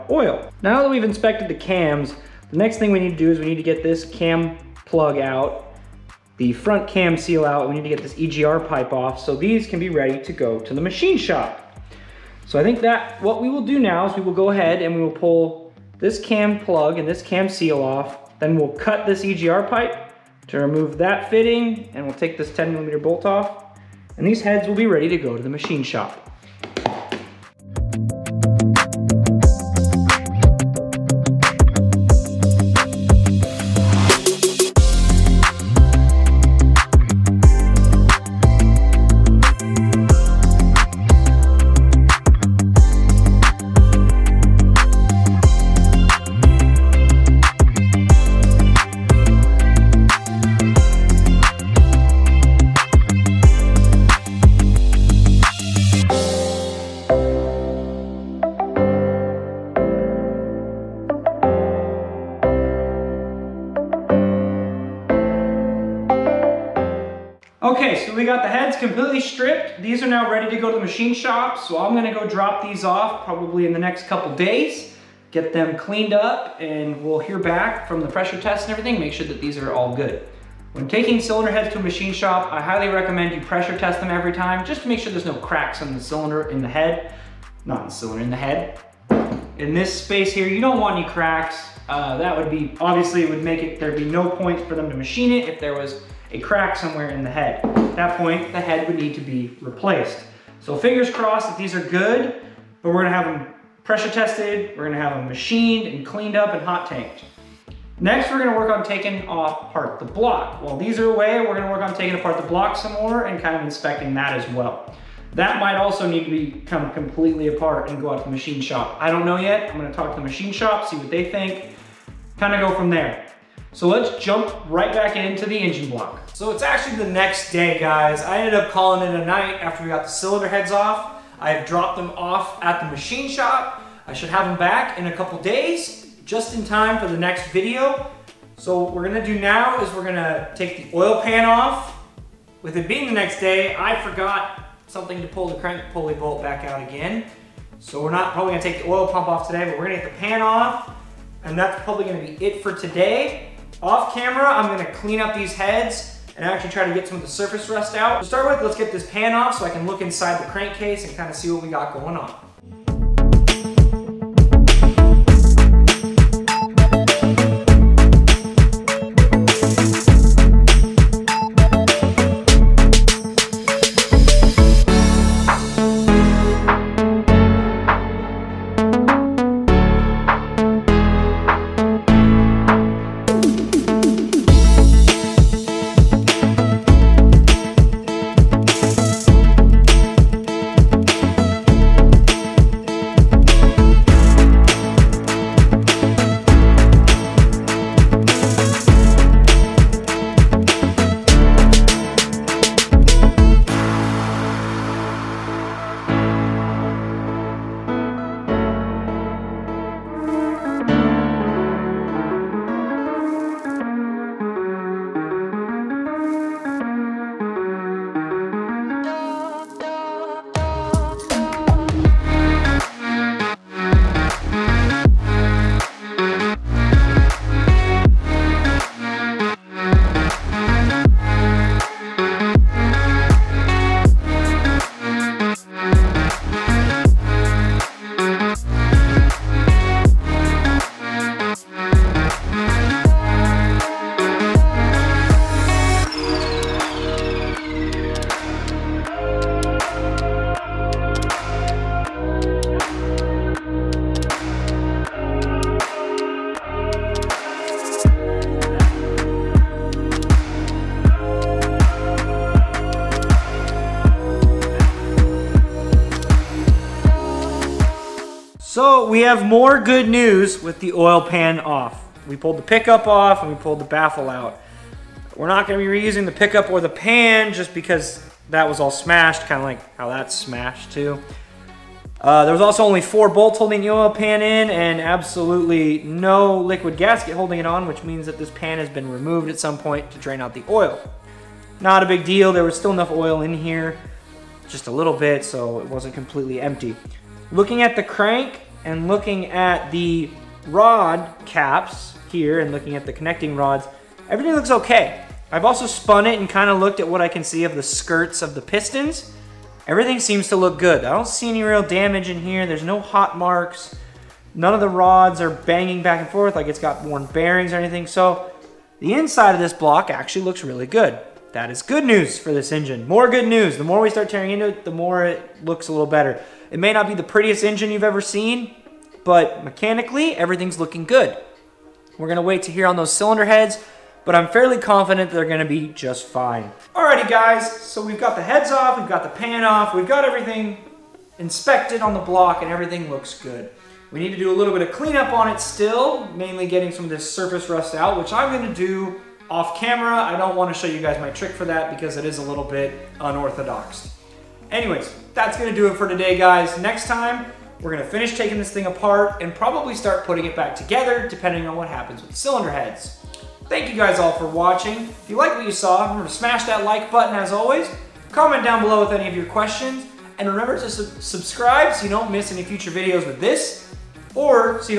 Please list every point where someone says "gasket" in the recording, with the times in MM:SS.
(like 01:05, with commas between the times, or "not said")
04:46.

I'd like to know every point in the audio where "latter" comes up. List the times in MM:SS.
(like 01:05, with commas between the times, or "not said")
not said.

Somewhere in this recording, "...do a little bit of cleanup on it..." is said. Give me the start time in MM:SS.
05:44.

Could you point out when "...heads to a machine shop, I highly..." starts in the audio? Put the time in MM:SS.
01:21.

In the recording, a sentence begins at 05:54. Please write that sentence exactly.
Anyways, that's gonna do it for today, guys.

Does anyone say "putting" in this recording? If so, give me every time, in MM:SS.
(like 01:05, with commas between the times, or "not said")
06:00.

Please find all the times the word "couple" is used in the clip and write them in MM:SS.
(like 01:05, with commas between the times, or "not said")
01:14, 02:15.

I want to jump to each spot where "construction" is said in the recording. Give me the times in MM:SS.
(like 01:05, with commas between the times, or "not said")
not said.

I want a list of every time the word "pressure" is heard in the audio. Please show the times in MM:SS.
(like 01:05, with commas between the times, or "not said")
01:18, 01:23, 01:43.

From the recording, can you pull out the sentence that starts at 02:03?
So let's jump right back into the engine block.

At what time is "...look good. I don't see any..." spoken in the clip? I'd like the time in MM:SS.
05:10.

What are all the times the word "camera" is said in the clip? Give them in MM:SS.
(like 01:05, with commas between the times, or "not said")
02:34, 05:49.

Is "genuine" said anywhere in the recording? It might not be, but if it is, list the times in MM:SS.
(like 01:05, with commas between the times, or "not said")
not said.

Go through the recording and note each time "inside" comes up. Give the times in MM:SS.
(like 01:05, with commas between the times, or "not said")
02:40, 05:19.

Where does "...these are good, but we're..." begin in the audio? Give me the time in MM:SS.
01:41.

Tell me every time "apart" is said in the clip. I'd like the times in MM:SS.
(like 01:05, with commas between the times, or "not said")
01:52, 01:57, 05:58.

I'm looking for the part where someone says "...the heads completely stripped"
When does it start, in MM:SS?
01:08.